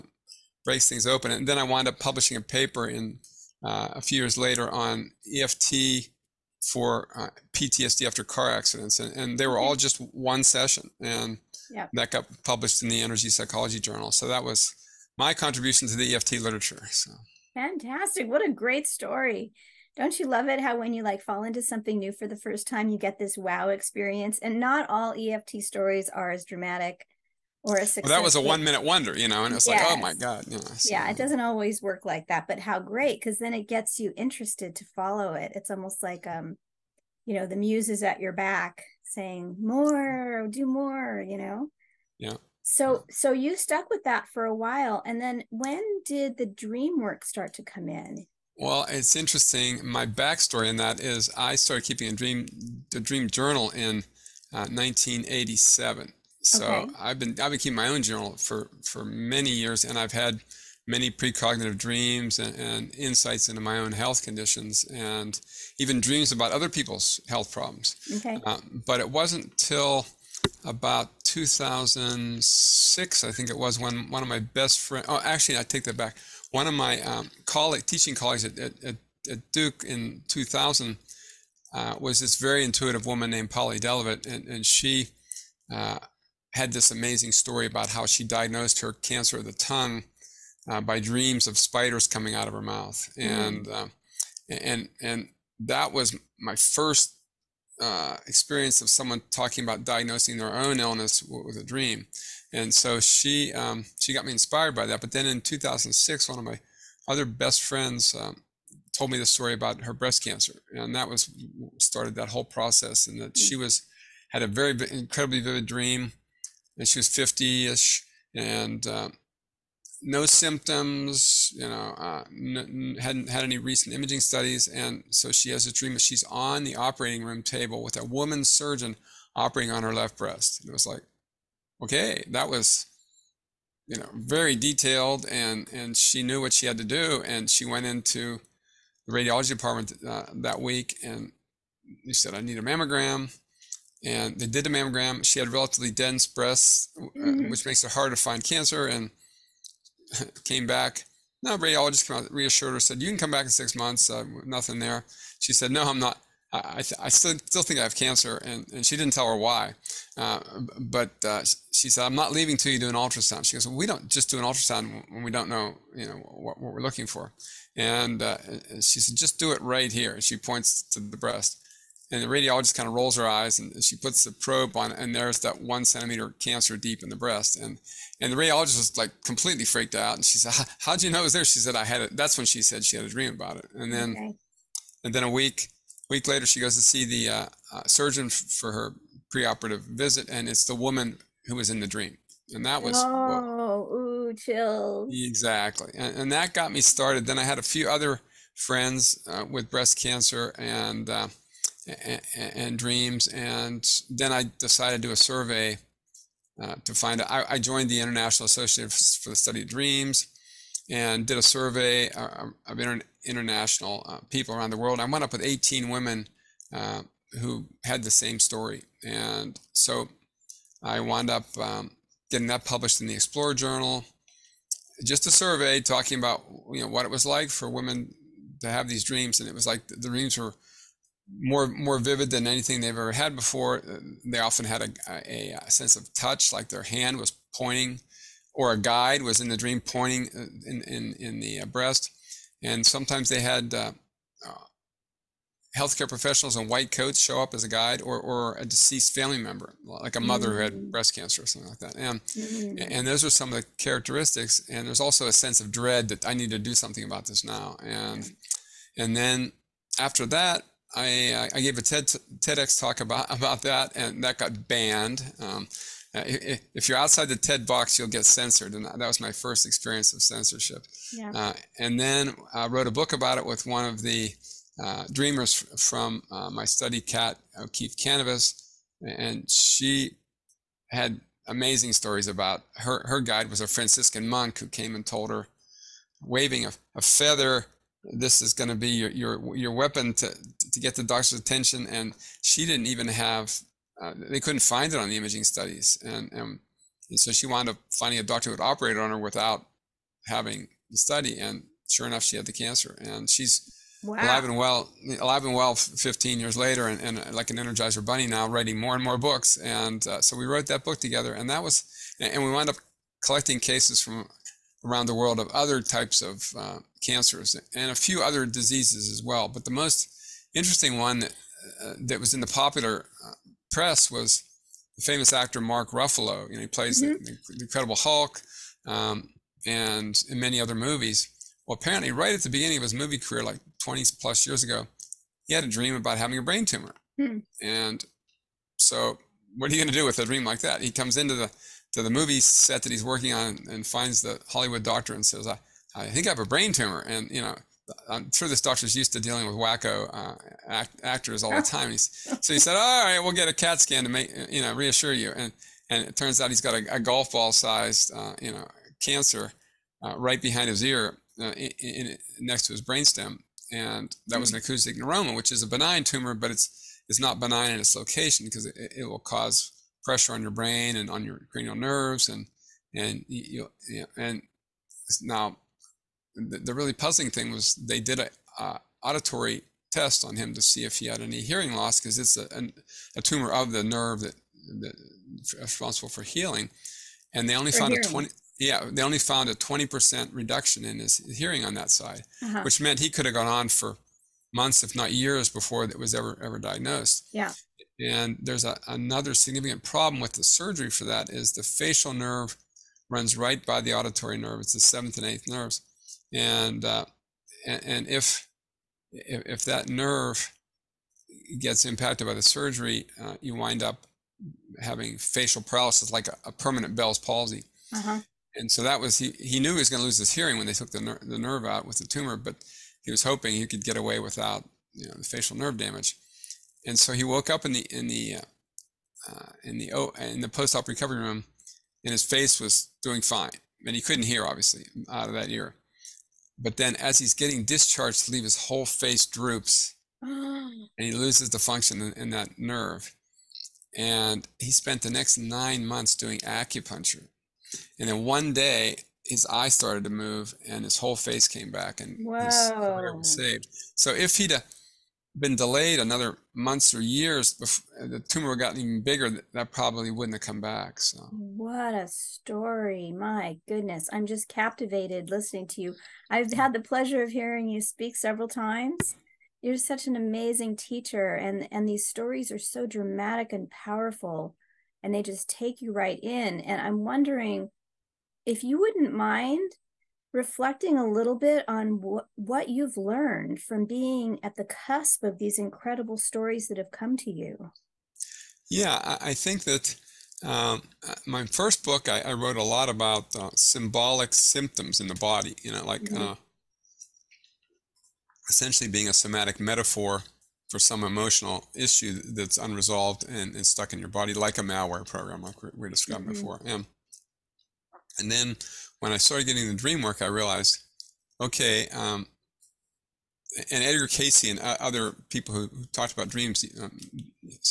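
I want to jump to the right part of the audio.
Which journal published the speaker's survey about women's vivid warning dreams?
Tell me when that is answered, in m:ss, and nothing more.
3:43.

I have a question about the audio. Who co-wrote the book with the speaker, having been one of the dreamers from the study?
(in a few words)
Cat O'Keefe Kanavos.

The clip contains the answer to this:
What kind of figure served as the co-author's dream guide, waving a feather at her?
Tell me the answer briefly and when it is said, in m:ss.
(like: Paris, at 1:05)
Franciscan monk, at 4:43.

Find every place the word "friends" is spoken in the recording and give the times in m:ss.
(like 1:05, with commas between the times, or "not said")
1:14, 1:47, 3:18.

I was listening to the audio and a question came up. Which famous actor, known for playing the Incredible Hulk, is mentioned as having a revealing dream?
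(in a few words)
Mark Ruffalo.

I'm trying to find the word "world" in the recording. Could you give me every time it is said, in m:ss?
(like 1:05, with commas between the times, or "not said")
3:34, 5:15.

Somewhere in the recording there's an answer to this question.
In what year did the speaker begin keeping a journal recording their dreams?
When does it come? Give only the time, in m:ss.
0:54.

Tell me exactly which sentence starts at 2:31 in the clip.
No, radiologist came out, reassured her, said, "You can come back in six months.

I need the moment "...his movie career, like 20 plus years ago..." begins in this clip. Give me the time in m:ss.
5:32.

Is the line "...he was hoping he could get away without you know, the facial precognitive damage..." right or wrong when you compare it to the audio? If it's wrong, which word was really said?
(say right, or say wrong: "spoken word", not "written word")
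wrong: "nerve", not "precognitive".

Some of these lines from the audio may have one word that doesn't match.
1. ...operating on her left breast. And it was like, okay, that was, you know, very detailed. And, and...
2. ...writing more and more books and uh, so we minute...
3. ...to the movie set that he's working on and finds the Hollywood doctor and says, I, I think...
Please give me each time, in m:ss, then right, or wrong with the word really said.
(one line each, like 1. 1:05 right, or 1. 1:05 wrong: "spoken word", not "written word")
1. 2:09 right
2. 5:08 wrong: "wrote", not "minute"
3. 5:41 right.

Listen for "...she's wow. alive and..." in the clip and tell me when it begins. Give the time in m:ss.
5:03.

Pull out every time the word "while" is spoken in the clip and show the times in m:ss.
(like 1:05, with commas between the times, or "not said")
0:44.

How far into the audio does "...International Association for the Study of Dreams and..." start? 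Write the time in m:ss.
3:27.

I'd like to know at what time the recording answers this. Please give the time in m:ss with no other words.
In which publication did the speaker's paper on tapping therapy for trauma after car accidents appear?
0:12.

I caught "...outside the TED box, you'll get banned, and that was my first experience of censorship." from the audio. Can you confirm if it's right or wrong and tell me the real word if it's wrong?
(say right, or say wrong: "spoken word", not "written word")
wrong: "censored", not "banned".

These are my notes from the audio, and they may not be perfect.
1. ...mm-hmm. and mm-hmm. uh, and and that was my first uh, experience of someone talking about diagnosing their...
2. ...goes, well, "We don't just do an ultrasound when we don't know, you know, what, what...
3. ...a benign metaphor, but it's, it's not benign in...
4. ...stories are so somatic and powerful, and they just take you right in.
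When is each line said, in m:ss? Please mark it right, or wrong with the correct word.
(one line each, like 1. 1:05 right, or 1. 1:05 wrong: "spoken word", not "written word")
1. 1:33 right
2. 2:43 right
3. 6:05 wrong: "tumor", not "metaphor"
4. 7:52 wrong: "dramatic", not "somatic".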